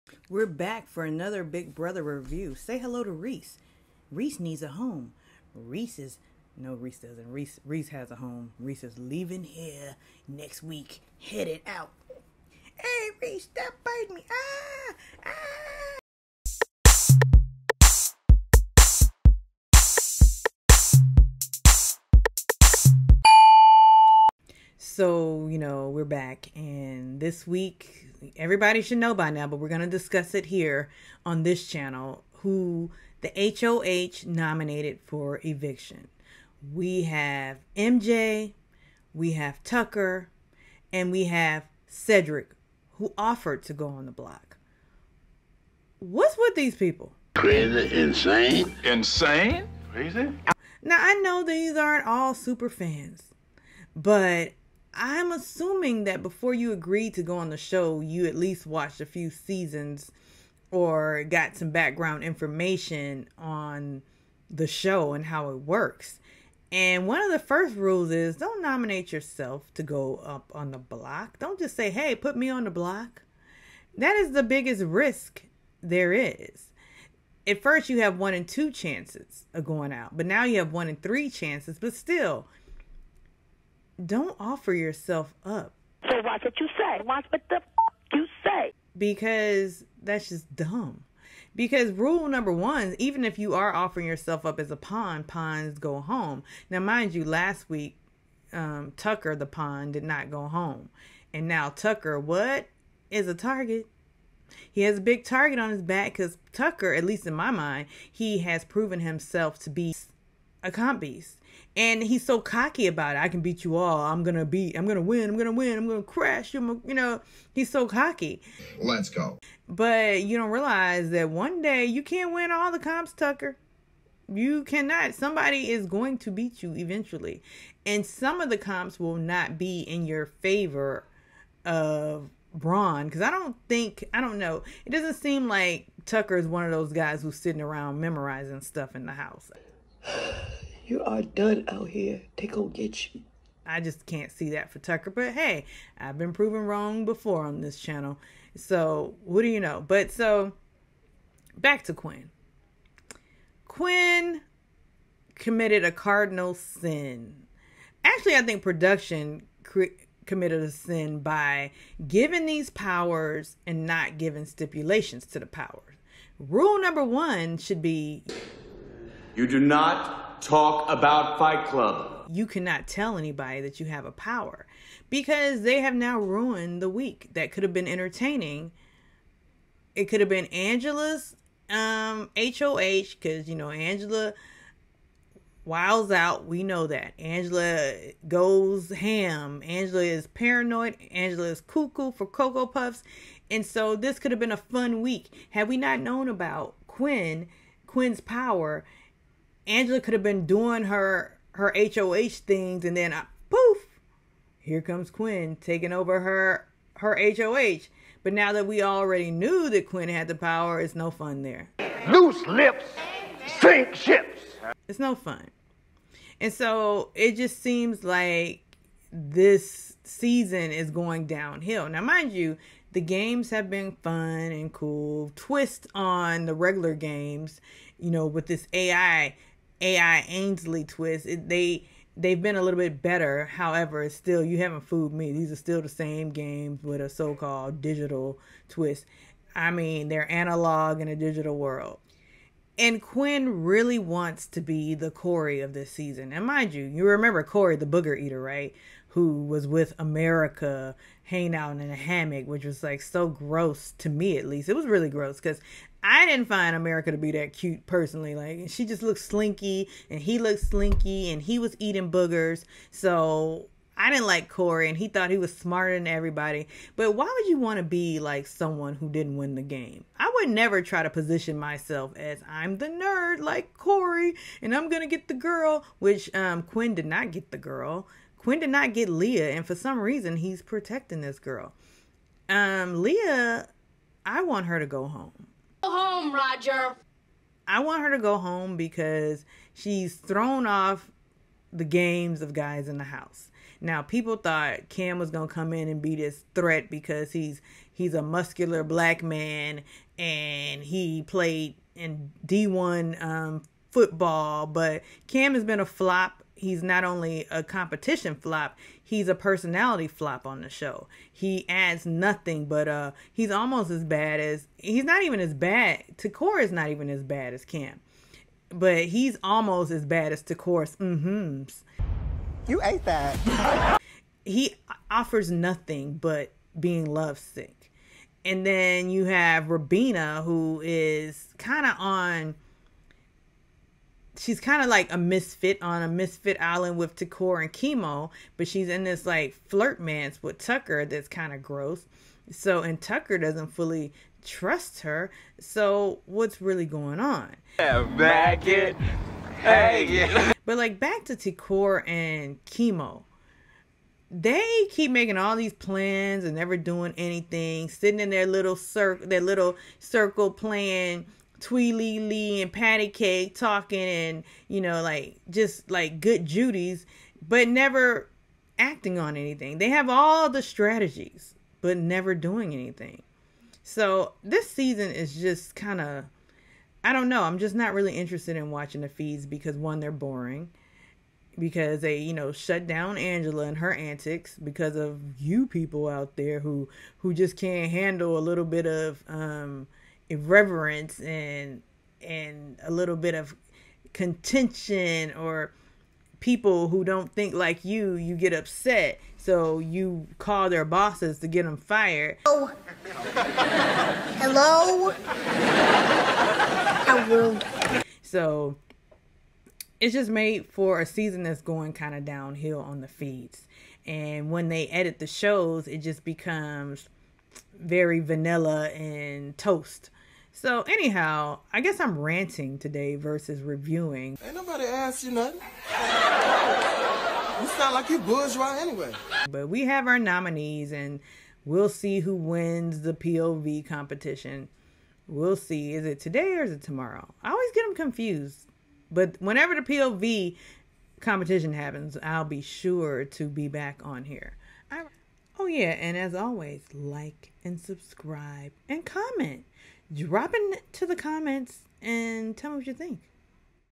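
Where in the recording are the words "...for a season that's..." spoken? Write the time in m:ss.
6:50.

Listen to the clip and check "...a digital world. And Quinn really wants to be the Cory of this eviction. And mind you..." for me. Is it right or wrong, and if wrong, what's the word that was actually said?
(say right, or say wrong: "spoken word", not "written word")
wrong: "season", not "eviction".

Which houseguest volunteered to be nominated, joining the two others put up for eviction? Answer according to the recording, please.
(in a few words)
Cedric.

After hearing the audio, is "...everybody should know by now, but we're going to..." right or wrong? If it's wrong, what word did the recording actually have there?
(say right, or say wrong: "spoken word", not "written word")
right.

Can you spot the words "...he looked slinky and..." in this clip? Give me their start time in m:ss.
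4:20.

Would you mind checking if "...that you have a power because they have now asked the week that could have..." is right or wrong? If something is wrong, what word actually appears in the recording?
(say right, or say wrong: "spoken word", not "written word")
wrong: "ruined", not "asked".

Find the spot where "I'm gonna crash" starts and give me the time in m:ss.
1:55.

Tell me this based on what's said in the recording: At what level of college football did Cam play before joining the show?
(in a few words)
D1.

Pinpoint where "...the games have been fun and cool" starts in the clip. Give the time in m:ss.
3:42.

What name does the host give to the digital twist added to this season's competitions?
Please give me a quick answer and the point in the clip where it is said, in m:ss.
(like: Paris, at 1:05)
Ainsley, at 3:48.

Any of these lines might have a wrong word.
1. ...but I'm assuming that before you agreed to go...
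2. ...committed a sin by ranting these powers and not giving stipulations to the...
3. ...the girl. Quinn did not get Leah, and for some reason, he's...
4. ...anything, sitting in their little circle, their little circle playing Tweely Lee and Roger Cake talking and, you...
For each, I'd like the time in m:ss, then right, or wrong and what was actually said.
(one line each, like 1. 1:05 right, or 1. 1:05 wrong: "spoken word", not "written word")
1. 0:53 right
2. 2:40 wrong: "giving", not "ranting"
3. 4:37 right
4. 5:57 wrong: "Patty", not "Roger".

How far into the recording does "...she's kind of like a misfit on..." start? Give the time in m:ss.
5:34.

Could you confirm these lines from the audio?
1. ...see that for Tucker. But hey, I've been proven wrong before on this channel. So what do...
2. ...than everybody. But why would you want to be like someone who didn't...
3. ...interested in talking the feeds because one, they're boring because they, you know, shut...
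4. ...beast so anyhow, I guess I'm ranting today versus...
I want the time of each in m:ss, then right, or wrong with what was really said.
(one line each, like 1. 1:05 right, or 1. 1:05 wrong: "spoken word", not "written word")
1. 2:24 right
2. 4:25 right
3. 6:18 wrong: "watching", not "talking"
4. 6:59 wrong: "toast", not "beast".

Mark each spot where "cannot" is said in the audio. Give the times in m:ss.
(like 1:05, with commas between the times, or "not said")
2:04, 2:52.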